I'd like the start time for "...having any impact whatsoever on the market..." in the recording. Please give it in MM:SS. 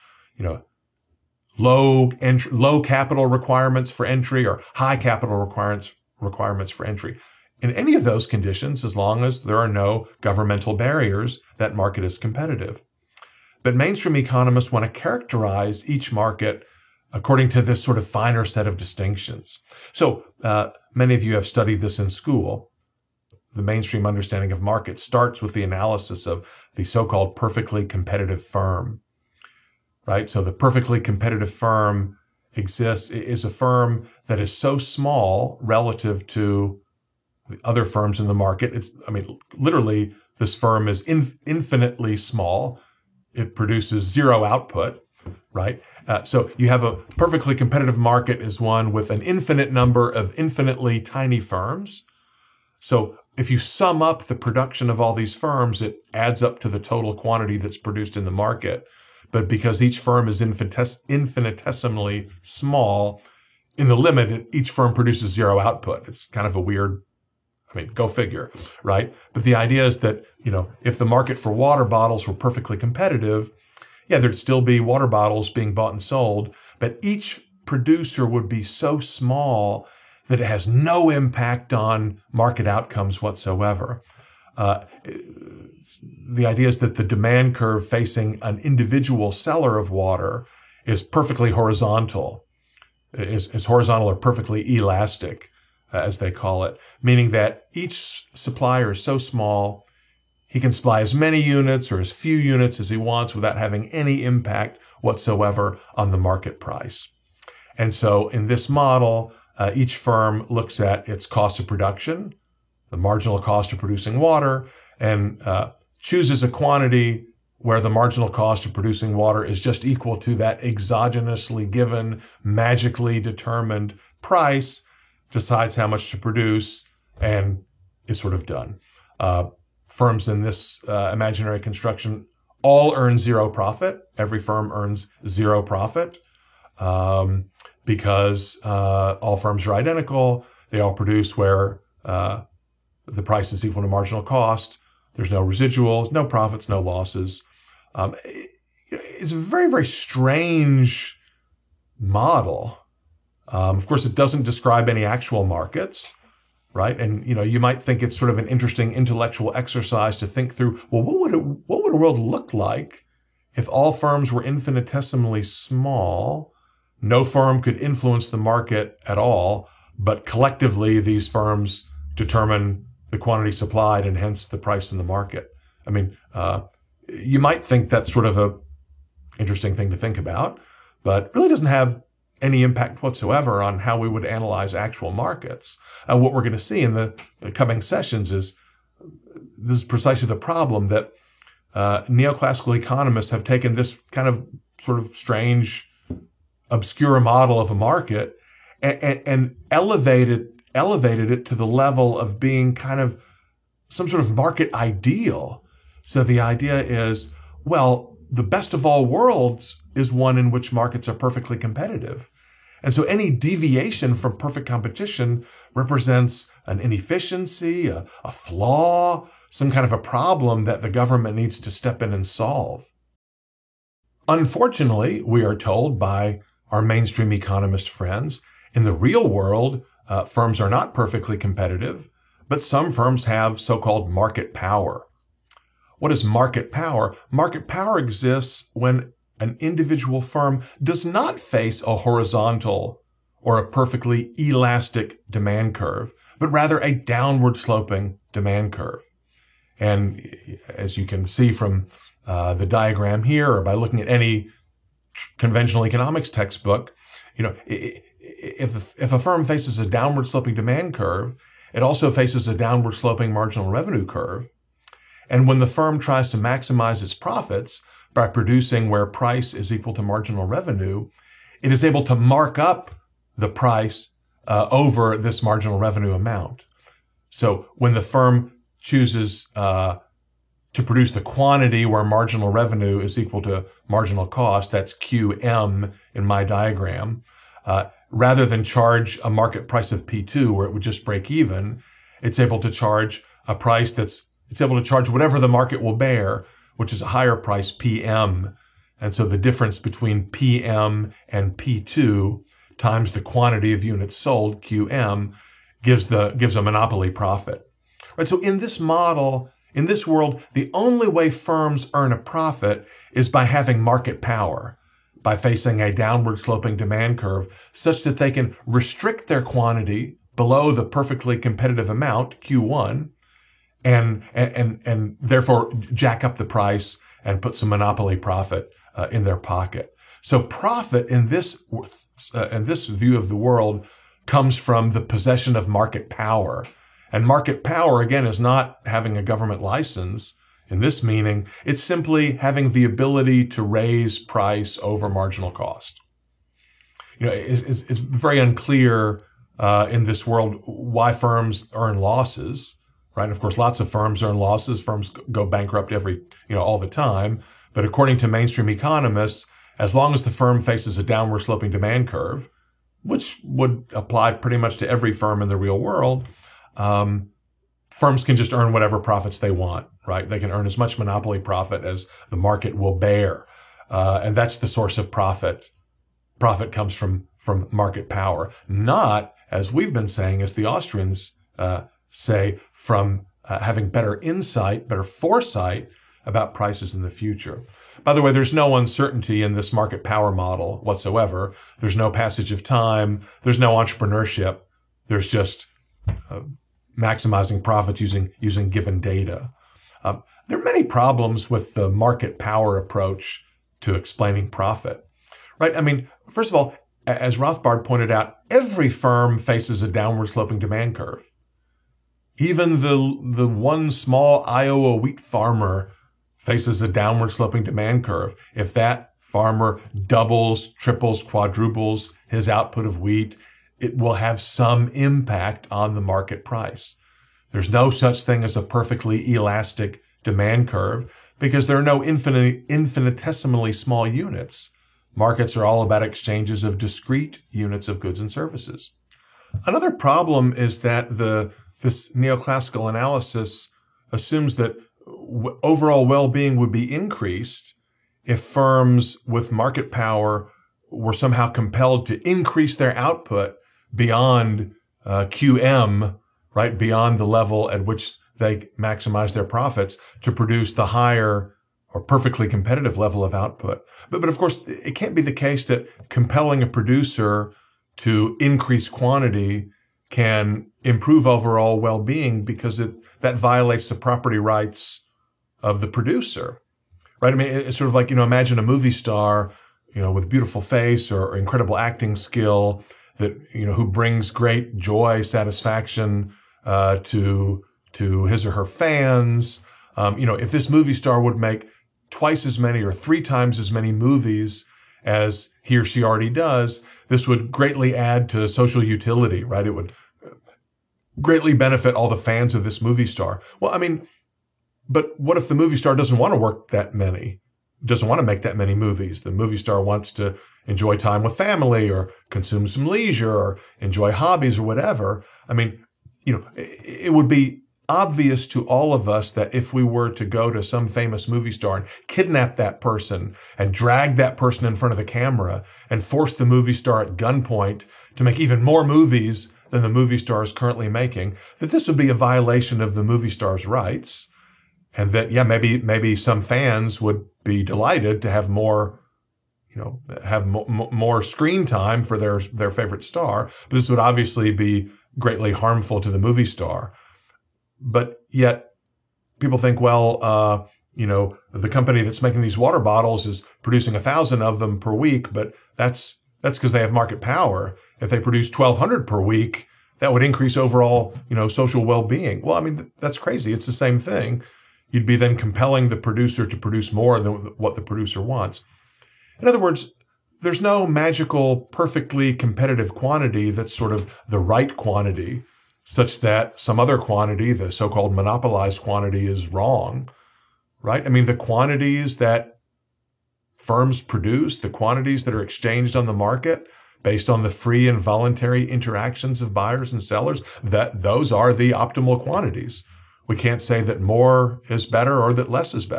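01:43.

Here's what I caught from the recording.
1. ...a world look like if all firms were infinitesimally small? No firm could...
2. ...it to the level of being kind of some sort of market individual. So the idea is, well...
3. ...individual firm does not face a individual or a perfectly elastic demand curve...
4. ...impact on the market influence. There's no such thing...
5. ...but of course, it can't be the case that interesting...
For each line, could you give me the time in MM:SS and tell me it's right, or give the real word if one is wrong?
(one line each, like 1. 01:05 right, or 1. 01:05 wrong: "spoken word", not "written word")
1. 02:41 right
2. 03:21 wrong: "ideal", not "individual"
3. 03:59 wrong: "horizontal", not "individual"
4. 07:04 wrong: "price", not "influence"
5. 07:44 wrong: "compelling", not "interesting".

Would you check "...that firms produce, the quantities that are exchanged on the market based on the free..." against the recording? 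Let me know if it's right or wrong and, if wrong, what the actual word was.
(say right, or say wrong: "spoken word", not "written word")
right.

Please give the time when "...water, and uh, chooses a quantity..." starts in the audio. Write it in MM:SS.
01:54.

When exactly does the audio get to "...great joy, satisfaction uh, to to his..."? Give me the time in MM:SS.
08:04.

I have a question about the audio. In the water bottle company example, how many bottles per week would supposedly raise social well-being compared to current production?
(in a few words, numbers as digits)
1,200.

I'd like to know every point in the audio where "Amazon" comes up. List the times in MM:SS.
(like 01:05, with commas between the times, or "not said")
not said.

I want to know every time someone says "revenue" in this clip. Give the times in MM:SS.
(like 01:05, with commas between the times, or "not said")
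04:23, 04:30, 04:35, 04:42.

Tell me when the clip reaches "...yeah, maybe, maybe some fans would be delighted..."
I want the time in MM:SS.
08:55.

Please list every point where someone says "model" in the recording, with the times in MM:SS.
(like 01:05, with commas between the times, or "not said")
01:48, 02:32, 03:17, 05:08, 06:30.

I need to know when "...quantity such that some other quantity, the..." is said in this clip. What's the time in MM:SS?
09:34.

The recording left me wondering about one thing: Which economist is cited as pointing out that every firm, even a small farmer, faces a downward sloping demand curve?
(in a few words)
Rothbard.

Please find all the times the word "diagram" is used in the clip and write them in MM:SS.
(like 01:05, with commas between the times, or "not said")
04:12, 04:46.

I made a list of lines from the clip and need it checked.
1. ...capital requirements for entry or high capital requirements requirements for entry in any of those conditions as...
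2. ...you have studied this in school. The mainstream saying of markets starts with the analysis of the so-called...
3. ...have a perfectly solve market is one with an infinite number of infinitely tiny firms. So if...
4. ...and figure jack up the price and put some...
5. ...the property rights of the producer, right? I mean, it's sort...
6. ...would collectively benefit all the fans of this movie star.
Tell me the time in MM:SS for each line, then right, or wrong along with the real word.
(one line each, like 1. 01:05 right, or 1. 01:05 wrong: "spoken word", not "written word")
1. 00:02 right
2. 00:21 wrong: "understanding", not "saying"
3. 00:46 wrong: "competitive", not "solve"
4. 05:24 wrong: "therefore", not "figure"
5. 07:53 right
6. 08:19 wrong: "greatly", not "collectively".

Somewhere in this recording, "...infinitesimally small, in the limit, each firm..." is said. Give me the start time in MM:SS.
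01:01.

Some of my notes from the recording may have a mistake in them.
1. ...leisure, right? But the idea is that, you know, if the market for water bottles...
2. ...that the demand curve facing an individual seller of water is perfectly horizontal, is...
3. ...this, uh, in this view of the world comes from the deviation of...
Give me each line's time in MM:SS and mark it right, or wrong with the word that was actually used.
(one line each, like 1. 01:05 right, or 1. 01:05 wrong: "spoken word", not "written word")
1. 01:08 wrong: "figure", not "leisure"
2. 01:26 right
3. 05:31 wrong: "possession", not "deviation".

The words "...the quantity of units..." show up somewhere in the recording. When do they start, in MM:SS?
05:03.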